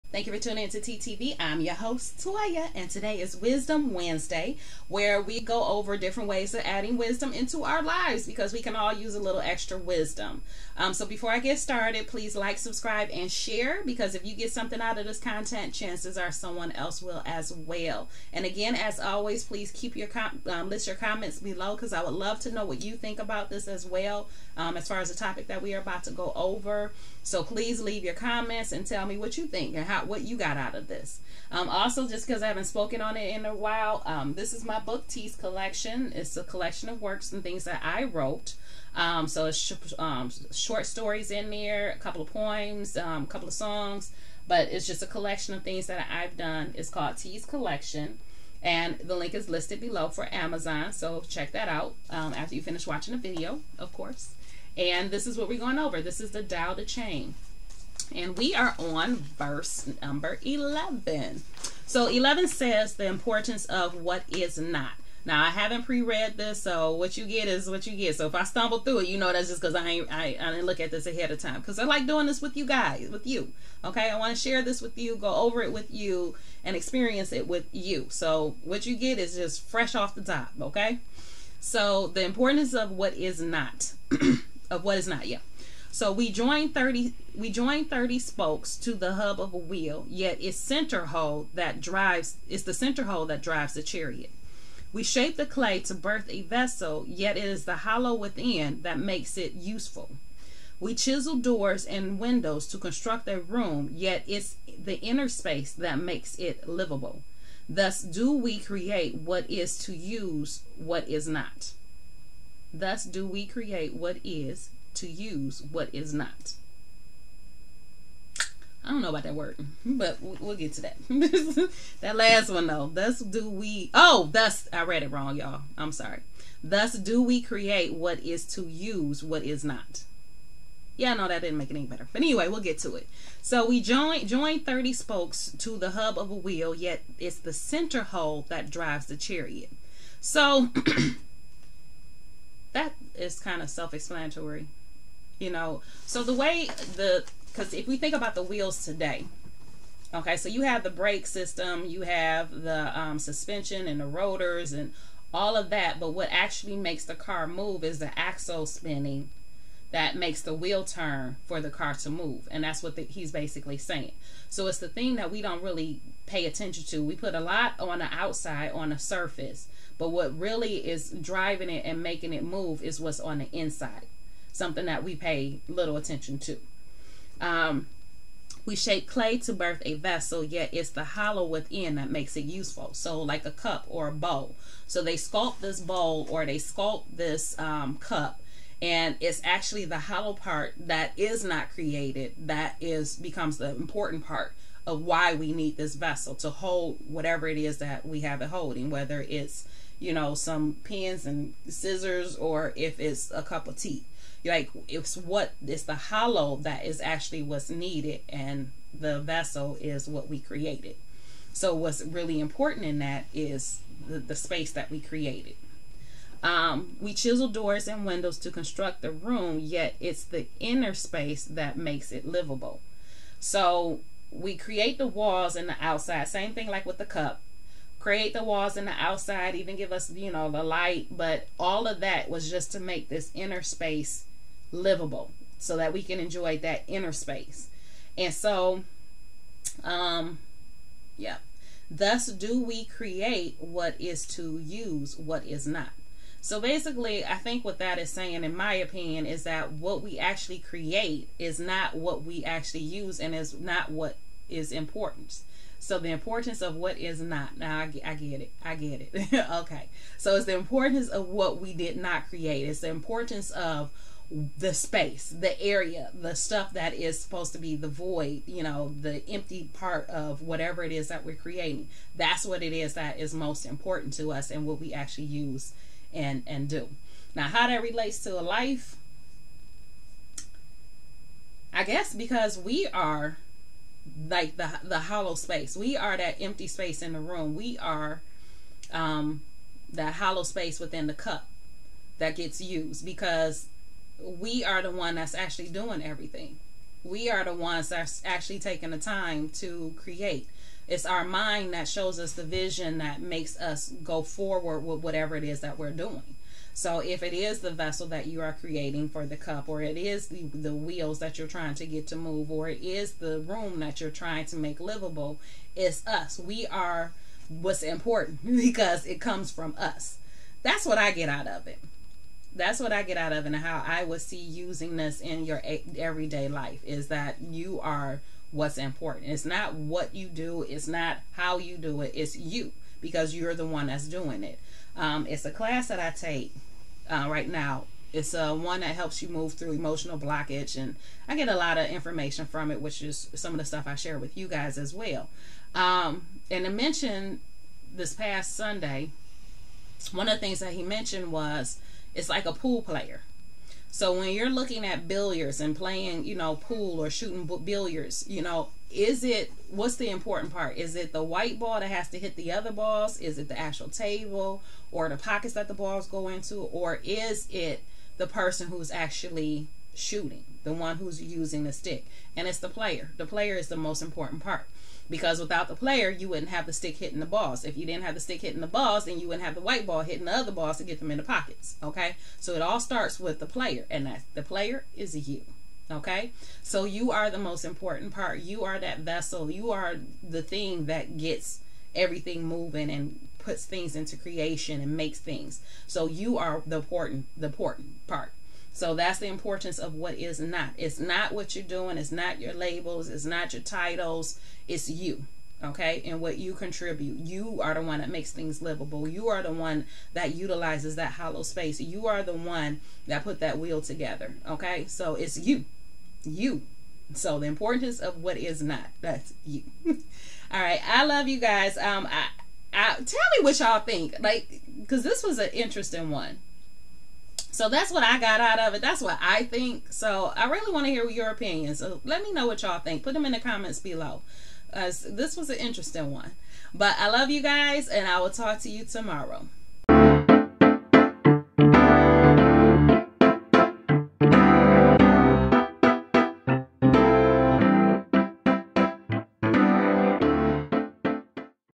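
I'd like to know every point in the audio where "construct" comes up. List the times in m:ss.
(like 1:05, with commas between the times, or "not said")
1:42, 3:38.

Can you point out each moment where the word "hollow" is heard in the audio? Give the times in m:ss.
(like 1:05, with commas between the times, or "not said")
1:37, 3:01, 3:09, 3:25, 4:44, 4:50, 6:51.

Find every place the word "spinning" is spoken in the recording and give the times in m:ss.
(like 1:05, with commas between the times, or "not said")
2:38.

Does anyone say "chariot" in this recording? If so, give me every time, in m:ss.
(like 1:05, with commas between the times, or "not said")
1:33, 2:19.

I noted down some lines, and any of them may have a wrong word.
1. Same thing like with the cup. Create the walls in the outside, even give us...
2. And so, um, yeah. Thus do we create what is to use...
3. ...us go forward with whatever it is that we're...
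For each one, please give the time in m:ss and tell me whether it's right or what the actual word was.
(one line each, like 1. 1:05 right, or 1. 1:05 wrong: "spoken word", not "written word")
1. 3:46 right
2. 3:58 right
3. 5:03 right.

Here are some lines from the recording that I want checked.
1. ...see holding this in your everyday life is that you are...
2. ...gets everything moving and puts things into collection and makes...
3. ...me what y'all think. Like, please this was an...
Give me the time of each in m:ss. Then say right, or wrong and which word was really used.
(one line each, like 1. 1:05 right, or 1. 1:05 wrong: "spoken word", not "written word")
1. 5:24 wrong: "using", not "holding"
2. 6:31 wrong: "creation", not "collection"
3. 7:03 wrong: "cause", not "please".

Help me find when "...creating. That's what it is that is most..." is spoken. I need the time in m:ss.
4:31.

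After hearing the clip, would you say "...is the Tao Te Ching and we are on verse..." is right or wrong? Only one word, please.
right.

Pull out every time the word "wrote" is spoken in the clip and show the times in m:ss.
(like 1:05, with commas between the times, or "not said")
0:38.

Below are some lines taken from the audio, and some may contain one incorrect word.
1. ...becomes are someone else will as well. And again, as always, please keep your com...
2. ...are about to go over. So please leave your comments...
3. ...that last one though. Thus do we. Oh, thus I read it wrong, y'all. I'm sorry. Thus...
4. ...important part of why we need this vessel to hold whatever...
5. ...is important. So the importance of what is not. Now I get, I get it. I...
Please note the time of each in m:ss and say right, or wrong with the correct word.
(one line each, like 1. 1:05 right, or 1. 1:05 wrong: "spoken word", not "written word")
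1. 0:15 wrong: "chances", not "becomes"
2. 0:25 right
3. 2:02 right
4. 3:13 right
5. 4:14 right.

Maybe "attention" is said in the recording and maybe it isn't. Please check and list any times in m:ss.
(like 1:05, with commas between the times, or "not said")
2:46, 2:55.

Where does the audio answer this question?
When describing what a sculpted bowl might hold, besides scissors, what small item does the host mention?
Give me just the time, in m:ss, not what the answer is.
3:20.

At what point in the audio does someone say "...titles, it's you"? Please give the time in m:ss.
6:43.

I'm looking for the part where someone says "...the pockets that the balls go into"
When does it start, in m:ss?
6:05.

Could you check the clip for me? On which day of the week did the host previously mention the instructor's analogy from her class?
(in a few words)
Sunday.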